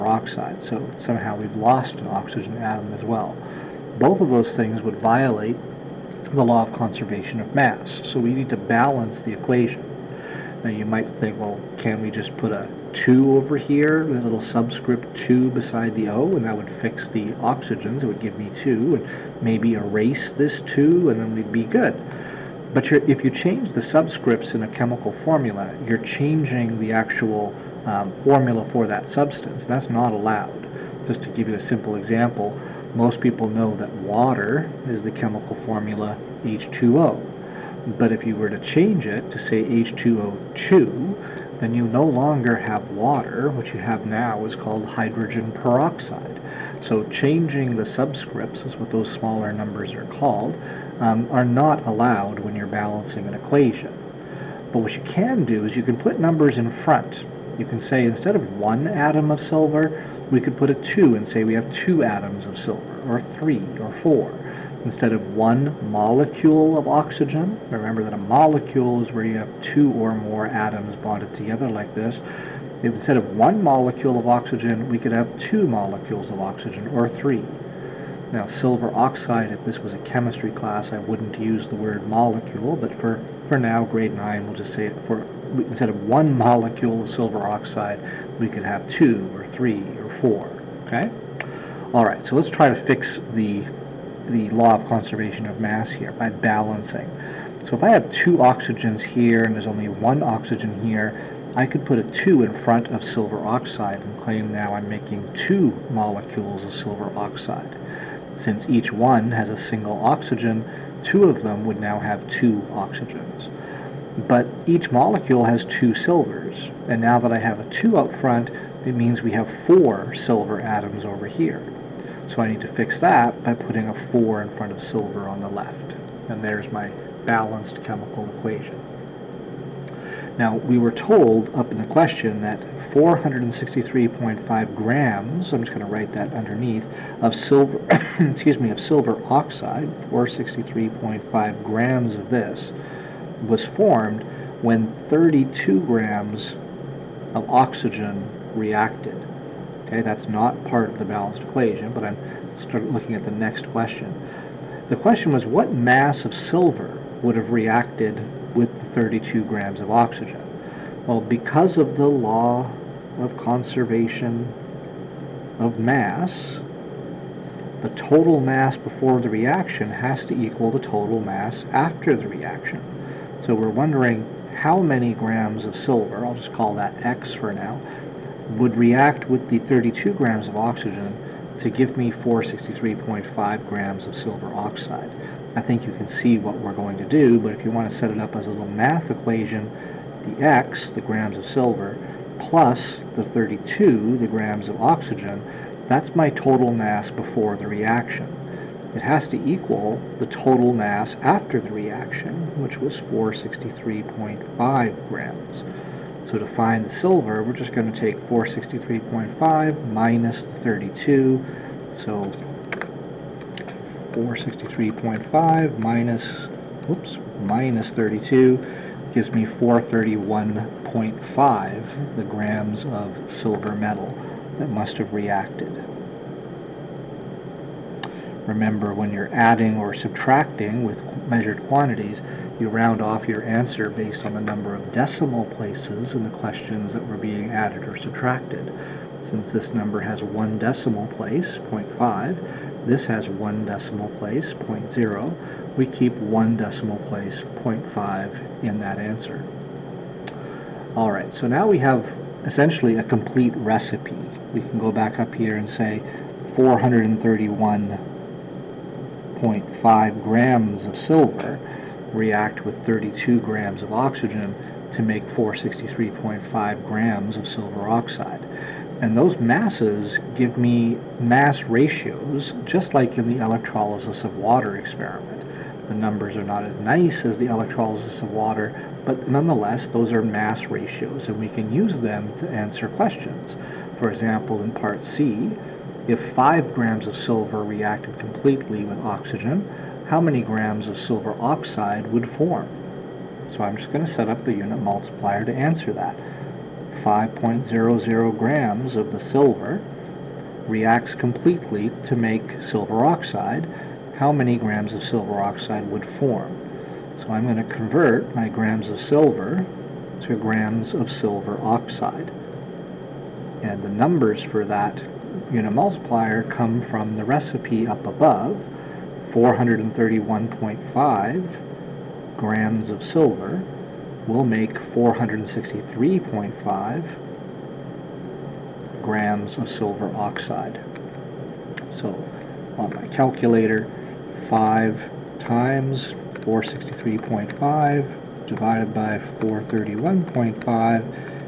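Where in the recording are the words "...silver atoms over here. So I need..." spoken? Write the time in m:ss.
2:00.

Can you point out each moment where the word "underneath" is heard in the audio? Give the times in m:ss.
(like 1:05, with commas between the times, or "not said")
2:16.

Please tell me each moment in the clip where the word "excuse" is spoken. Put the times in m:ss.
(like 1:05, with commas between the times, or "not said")
2:18.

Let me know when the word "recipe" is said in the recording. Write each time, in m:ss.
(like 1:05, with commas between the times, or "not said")
4:13, 5:17.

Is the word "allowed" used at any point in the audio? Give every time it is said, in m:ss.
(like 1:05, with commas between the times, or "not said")
0:30, 0:51.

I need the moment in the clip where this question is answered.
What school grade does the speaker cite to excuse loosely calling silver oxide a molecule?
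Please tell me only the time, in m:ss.
1:23.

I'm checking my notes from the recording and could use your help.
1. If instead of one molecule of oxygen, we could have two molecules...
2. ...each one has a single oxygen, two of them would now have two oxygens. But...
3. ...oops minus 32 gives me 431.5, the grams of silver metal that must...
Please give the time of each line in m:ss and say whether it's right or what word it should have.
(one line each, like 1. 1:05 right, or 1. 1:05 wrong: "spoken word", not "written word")
1. 1:12 right
2. 1:48 right
3. 3:36 right.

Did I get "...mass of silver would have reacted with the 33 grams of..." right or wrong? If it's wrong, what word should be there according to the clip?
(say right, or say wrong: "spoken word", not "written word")
wrong: "32", not "33".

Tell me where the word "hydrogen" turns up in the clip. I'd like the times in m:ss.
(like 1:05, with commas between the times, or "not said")
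0:44.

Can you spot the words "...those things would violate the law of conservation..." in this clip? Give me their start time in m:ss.
0:04.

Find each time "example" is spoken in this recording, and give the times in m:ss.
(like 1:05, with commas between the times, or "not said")
0:31, 4:44.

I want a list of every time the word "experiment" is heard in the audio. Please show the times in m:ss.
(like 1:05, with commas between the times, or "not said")
4:34.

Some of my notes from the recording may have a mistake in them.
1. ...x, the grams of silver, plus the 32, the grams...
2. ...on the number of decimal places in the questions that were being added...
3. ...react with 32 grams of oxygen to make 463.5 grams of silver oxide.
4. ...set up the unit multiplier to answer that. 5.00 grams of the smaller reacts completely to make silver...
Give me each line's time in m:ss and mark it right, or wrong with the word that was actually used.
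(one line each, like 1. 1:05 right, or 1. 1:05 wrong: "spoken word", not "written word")
1. 3:10 right
2. 3:54 right
3. 4:22 right
4. 4:54 wrong: "silver", not "smaller".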